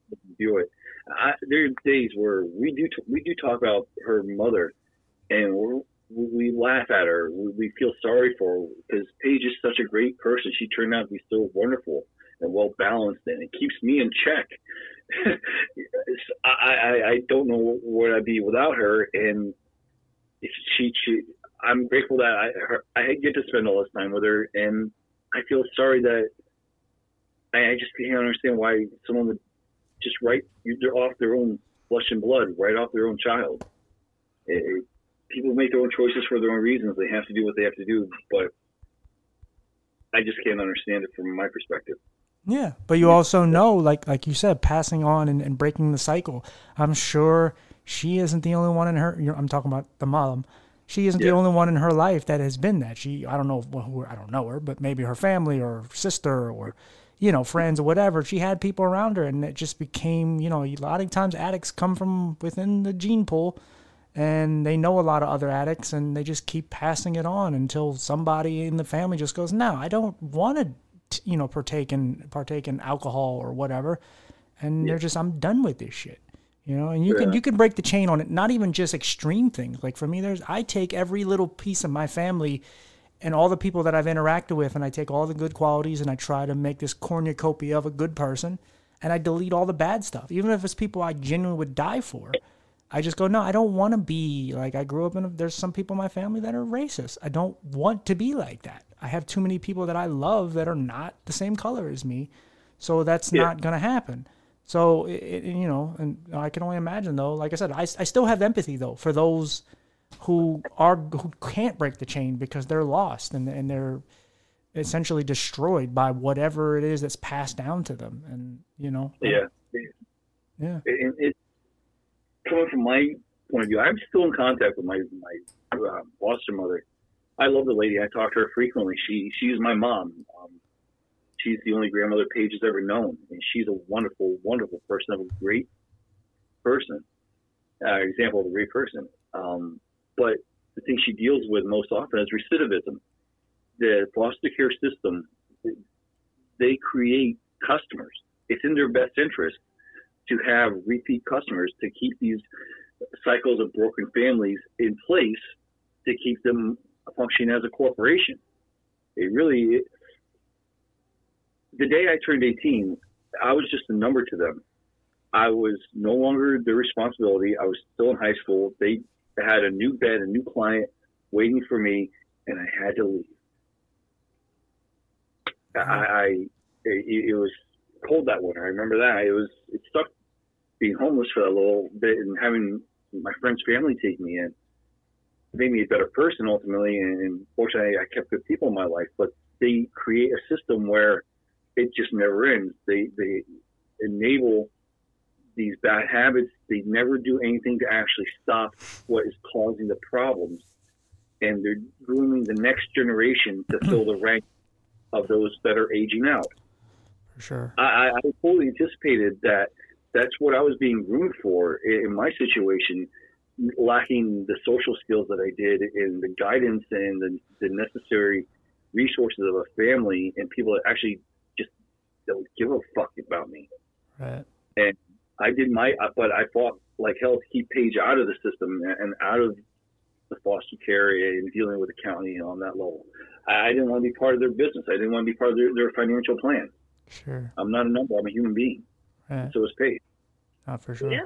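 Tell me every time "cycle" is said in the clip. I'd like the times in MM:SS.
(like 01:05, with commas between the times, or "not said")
00:45, 02:33.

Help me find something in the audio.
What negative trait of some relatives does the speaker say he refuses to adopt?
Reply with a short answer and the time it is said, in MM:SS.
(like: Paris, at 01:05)
racist, at 01:36.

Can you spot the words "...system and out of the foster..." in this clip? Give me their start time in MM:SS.
03:48.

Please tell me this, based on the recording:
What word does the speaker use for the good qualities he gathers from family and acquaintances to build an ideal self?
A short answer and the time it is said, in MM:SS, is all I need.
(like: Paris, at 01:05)
cornucopia, at 01:26.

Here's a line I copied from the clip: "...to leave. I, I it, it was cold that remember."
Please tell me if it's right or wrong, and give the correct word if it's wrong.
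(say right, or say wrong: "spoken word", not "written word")
wrong: "winter", not "remember".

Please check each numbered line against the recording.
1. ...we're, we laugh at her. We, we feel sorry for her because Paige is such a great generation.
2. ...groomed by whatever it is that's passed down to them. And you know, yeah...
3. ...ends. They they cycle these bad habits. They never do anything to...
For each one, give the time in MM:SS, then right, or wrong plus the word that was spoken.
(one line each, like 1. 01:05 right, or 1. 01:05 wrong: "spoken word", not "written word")
1. 00:05 wrong: "person", not "generation"
2. 01:55 wrong: "destroyed", not "groomed"
3. 03:12 wrong: "enable", not "cycle".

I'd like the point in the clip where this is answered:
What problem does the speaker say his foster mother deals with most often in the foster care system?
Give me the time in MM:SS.
02:22.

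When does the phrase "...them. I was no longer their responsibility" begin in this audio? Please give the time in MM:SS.
02:44.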